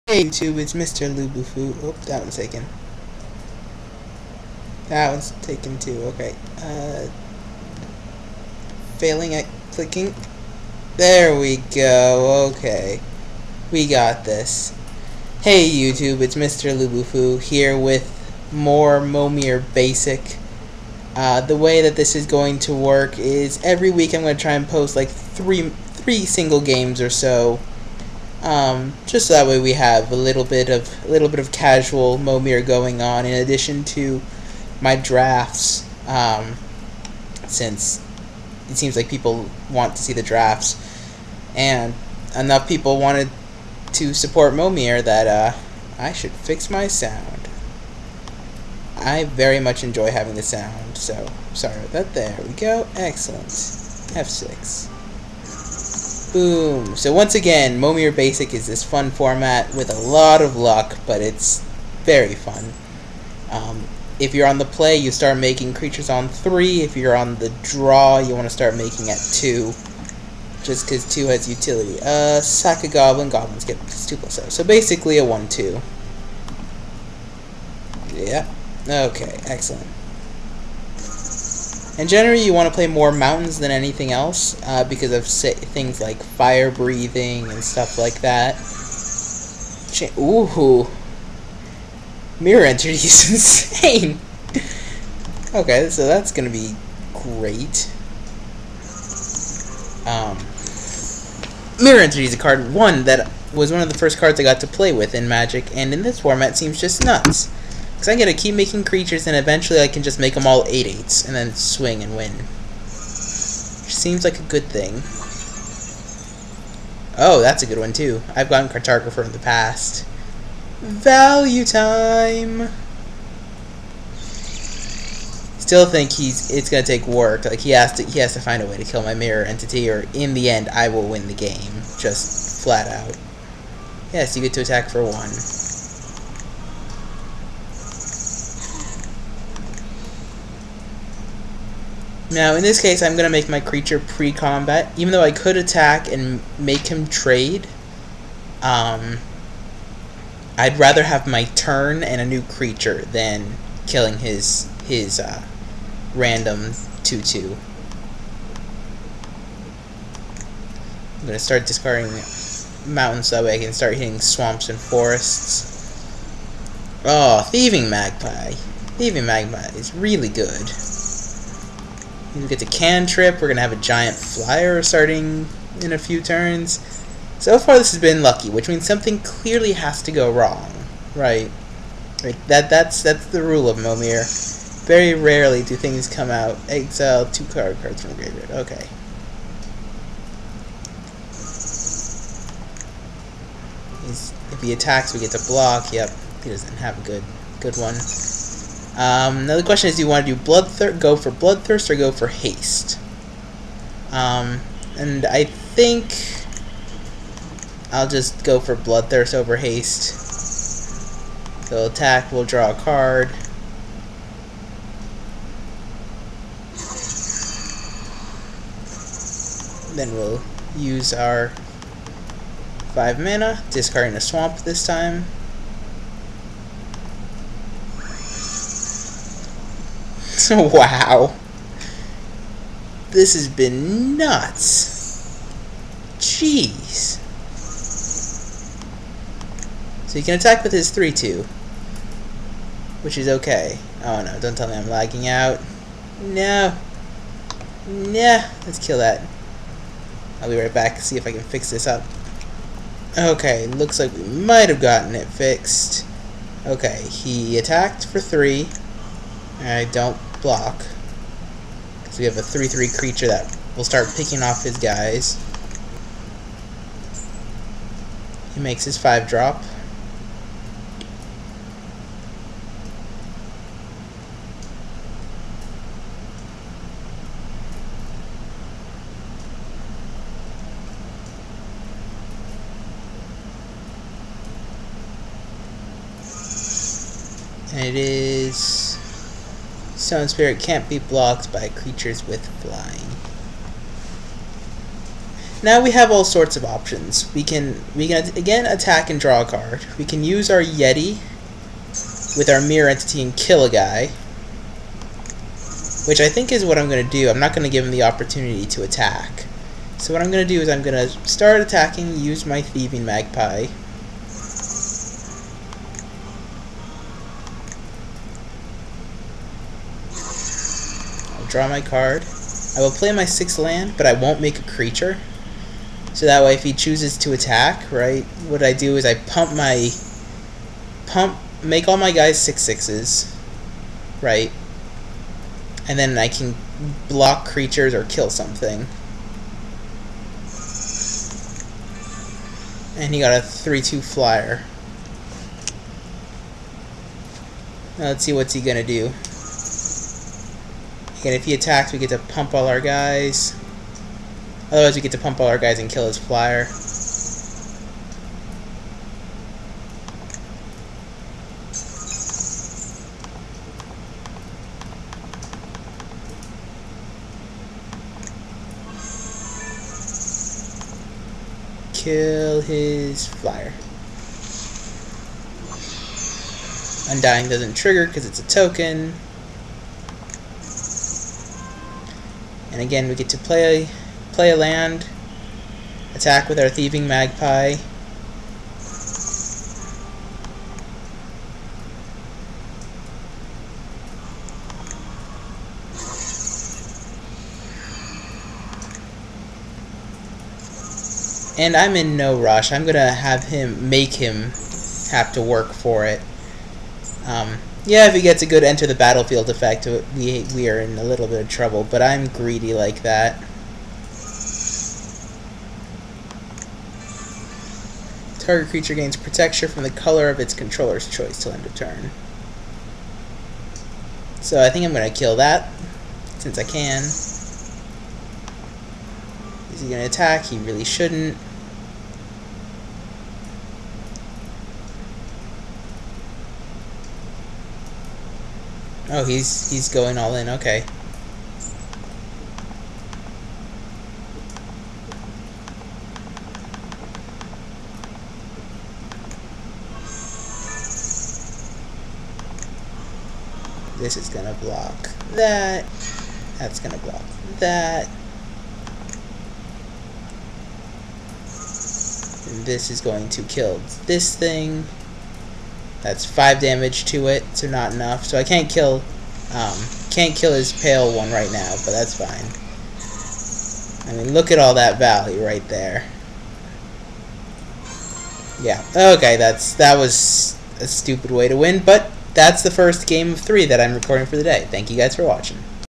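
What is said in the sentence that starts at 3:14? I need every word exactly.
He's, if he attacks, we get to block.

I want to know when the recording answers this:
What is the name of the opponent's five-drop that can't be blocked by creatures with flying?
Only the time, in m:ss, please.
4:50.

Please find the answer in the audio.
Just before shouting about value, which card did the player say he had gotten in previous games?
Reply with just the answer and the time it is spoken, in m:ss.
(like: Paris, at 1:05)
Cartographer, at 1:58.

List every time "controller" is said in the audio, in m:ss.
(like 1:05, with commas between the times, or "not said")
7:00.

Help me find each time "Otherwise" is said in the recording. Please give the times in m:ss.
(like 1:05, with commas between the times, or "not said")
5:54.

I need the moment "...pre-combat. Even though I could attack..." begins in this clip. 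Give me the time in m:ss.
2:23.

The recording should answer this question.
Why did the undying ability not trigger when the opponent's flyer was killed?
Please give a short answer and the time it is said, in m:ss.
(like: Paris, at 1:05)
it's a token, at 6:18.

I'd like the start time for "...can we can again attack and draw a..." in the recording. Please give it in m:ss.
4:57.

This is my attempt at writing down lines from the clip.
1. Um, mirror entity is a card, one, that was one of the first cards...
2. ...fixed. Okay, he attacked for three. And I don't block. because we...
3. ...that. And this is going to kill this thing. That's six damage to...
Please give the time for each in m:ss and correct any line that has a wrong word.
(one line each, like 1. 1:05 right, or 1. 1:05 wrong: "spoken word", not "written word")
1. 1:40 right
2. 4:15 right
3. 7:37 wrong: "five", not "six".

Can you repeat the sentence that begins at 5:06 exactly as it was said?
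Which I think is what I'm going to do.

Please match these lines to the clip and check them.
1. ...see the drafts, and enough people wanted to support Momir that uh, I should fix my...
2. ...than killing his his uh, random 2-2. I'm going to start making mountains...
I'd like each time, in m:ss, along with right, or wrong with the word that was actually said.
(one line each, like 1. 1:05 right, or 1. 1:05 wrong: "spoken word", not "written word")
1. 0:40 right
2. 2:33 wrong: "discarding", not "making".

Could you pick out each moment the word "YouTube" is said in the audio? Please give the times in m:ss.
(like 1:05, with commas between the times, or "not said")
0:00, 0:15.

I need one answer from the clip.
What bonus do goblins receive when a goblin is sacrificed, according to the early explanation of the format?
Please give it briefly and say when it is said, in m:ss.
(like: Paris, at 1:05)
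+2/+0, at 1:13.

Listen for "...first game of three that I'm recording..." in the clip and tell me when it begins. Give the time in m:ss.
8:02.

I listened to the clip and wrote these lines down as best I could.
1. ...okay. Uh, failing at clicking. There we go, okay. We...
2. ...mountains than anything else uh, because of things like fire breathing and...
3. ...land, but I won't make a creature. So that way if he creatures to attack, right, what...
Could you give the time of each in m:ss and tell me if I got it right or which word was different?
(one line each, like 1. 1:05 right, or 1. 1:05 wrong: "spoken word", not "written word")
1. 0:06 right
2. 1:23 right
3. 5:23 wrong: "chooses", not "creatures".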